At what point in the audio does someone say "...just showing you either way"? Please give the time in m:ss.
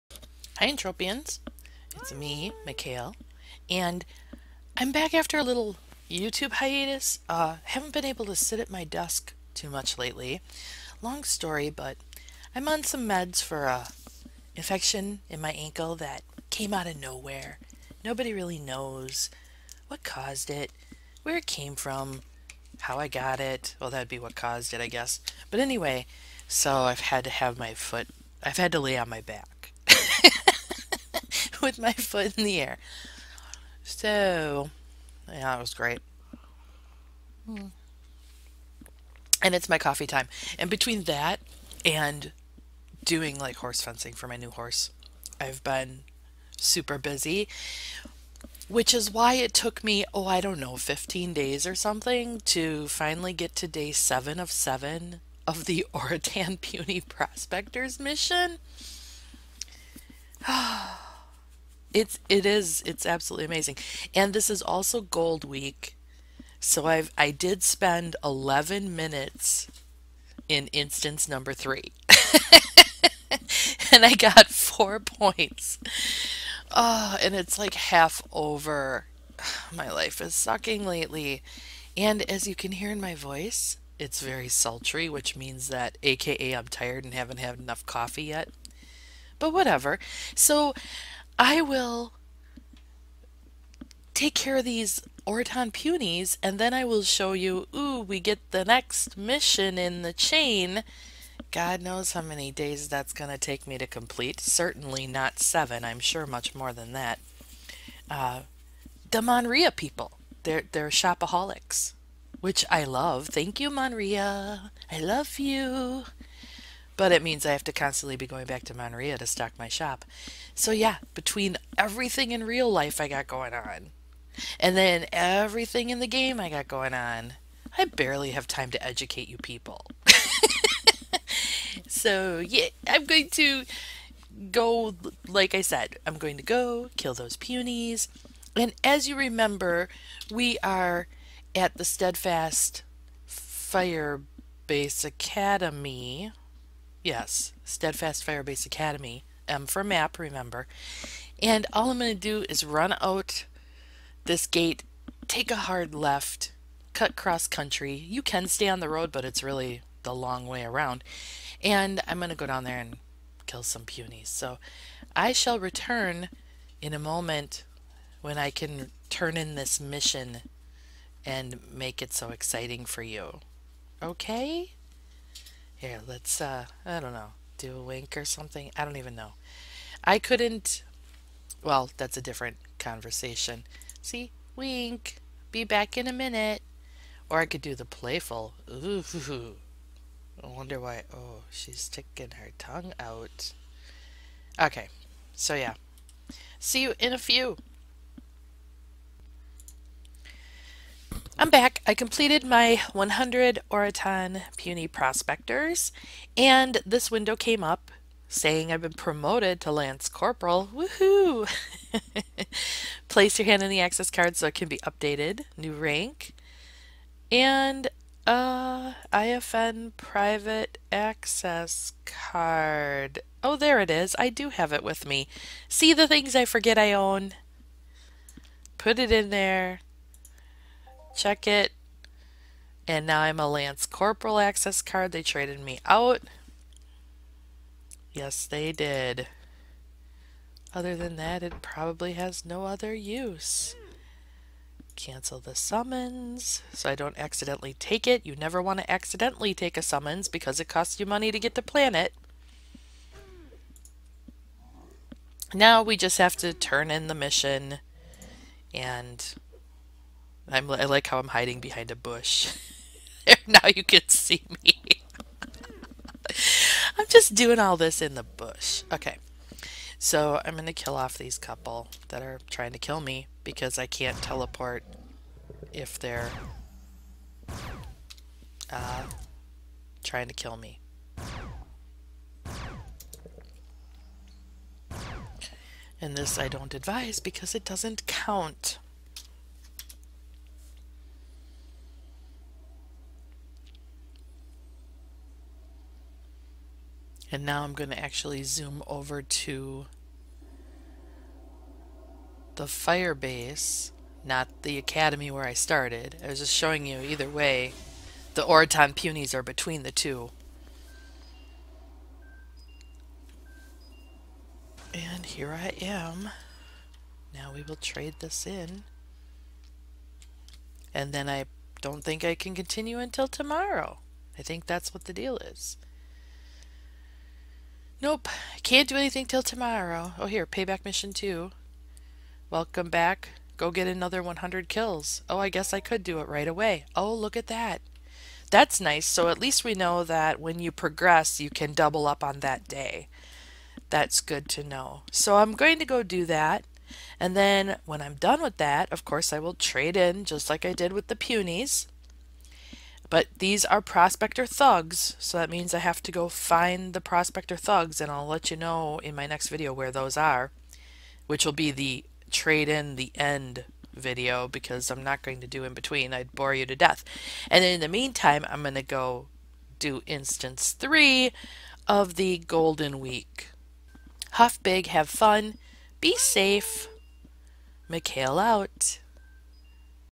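5:06.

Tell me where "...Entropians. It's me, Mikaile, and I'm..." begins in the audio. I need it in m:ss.
0:00.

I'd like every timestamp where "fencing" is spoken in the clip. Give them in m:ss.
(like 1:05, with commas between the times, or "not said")
0:43.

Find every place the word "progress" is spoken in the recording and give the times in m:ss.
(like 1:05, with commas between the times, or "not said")
5:40.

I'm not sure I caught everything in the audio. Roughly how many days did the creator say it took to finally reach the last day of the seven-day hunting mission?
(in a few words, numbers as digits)
15.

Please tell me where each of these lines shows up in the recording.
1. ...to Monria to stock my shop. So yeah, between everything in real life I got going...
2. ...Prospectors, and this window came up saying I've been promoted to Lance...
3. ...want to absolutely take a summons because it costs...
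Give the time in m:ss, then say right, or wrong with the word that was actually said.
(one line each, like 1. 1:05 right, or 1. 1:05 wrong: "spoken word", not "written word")
1. 1:58 right
2. 3:24 right
3. 4:08 wrong: "accidentally", not "absolutely".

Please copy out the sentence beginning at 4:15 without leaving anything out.
Now we just have to turn in the mission and I'm, I like how I'm hiding behind a bush.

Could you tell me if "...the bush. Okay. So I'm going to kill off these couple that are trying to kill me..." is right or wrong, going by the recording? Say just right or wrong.
right.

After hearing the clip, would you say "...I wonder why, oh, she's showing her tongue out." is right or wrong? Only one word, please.
wrong.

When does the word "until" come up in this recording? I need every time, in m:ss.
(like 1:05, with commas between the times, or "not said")
5:22.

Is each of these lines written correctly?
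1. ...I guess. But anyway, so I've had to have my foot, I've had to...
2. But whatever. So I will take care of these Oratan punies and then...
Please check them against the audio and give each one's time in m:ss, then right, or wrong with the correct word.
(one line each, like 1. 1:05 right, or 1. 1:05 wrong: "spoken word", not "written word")
1. 0:24 right
2. 1:29 right.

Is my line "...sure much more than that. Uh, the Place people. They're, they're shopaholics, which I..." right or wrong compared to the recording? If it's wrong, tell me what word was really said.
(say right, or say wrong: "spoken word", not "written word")
wrong: "Monria", not "Place".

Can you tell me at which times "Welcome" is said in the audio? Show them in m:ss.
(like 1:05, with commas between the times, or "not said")
5:32.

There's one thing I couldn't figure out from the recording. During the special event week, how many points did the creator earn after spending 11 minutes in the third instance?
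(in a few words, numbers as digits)
4.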